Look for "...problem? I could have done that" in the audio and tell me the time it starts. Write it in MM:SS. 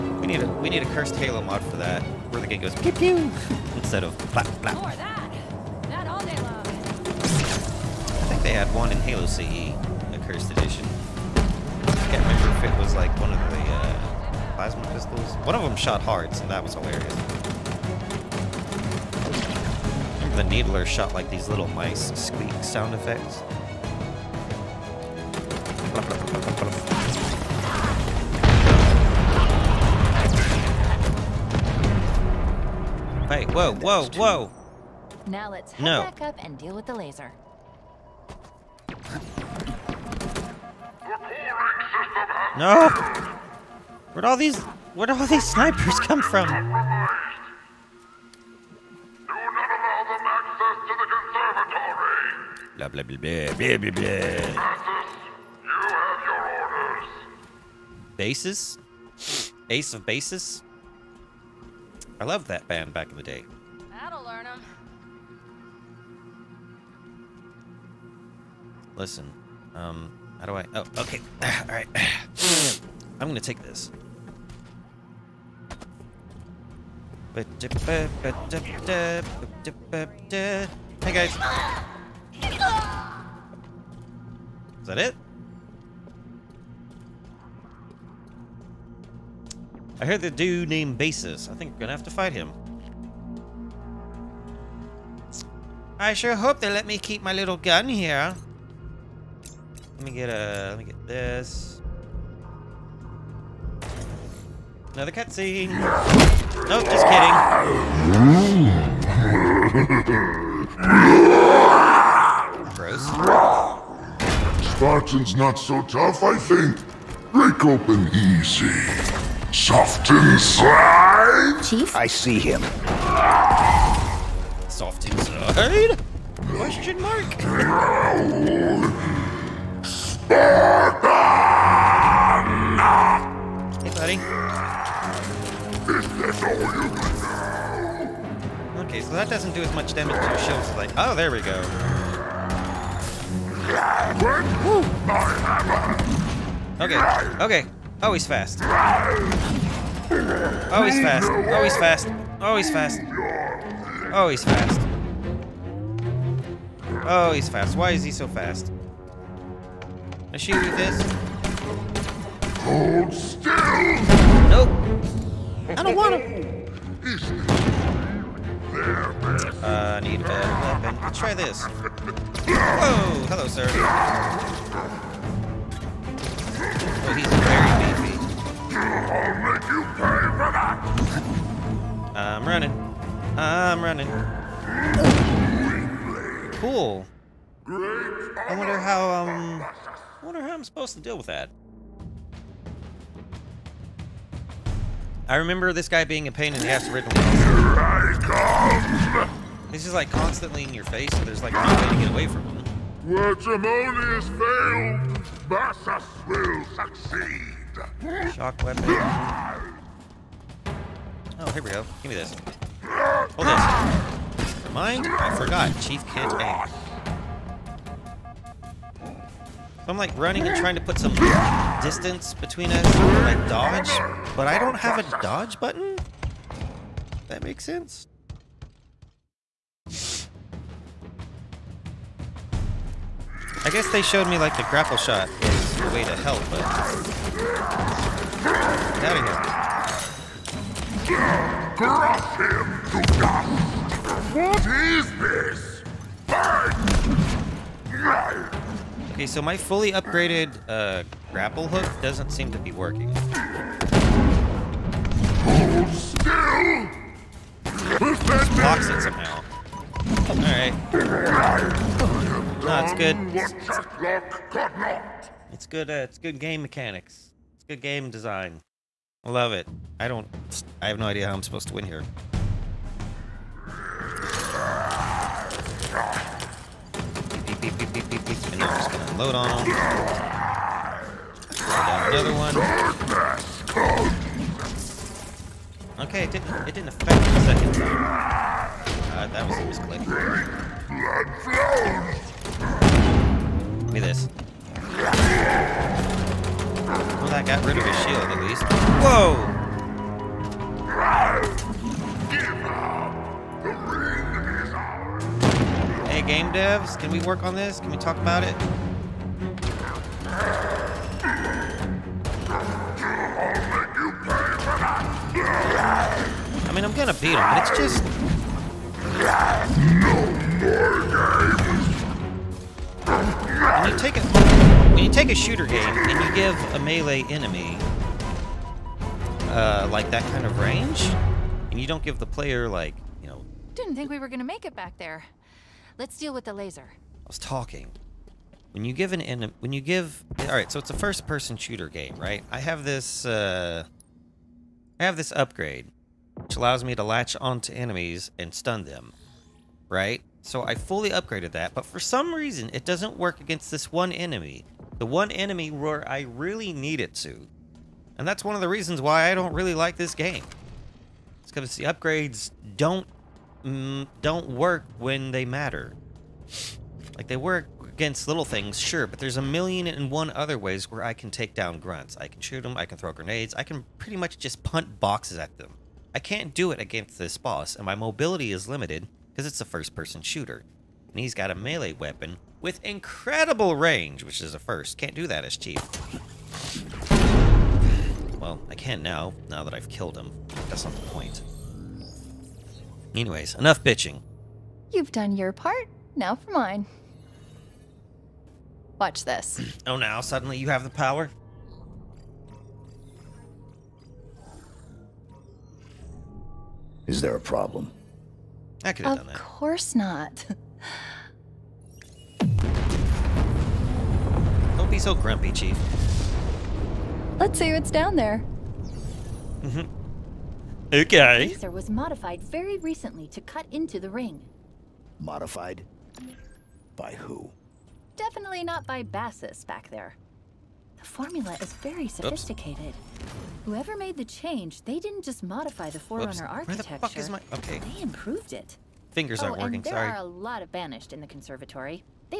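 06:47.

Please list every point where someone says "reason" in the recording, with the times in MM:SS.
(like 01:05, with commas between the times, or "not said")
05:52, 05:58.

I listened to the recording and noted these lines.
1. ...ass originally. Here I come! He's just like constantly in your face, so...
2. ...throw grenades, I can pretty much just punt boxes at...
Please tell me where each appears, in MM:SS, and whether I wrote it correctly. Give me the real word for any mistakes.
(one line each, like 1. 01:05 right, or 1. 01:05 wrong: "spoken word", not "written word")
1. 03:16 right
2. 06:12 right.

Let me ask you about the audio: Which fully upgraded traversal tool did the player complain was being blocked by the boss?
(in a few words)
Grapple hook.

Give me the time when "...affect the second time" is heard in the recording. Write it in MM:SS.
04:46.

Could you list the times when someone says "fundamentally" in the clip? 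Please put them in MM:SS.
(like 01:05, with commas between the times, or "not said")
not said.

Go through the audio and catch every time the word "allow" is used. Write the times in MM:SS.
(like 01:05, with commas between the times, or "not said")
00:46, 05:46.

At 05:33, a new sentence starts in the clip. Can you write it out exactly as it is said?
Didn't think we were gonna make it back there.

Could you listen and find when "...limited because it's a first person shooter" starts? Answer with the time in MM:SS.
06:18.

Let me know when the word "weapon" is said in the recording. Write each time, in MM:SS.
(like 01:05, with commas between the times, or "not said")
02:50, 03:28, 06:21.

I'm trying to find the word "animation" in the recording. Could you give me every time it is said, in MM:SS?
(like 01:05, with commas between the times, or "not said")
not said.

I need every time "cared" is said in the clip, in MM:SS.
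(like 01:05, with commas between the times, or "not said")
not said.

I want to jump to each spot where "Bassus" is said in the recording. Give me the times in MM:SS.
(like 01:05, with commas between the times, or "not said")
03:25, 07:09.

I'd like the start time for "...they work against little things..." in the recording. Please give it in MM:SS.
06:07.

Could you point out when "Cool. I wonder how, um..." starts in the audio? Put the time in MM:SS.
03:06.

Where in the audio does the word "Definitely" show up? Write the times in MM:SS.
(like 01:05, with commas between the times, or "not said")
07:08.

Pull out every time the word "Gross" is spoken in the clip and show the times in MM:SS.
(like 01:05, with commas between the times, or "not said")
01:52.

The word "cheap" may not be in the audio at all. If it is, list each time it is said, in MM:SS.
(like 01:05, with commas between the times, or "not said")
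06:25.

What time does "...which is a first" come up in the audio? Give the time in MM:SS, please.
06:24.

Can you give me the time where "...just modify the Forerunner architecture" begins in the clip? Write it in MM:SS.
07:15.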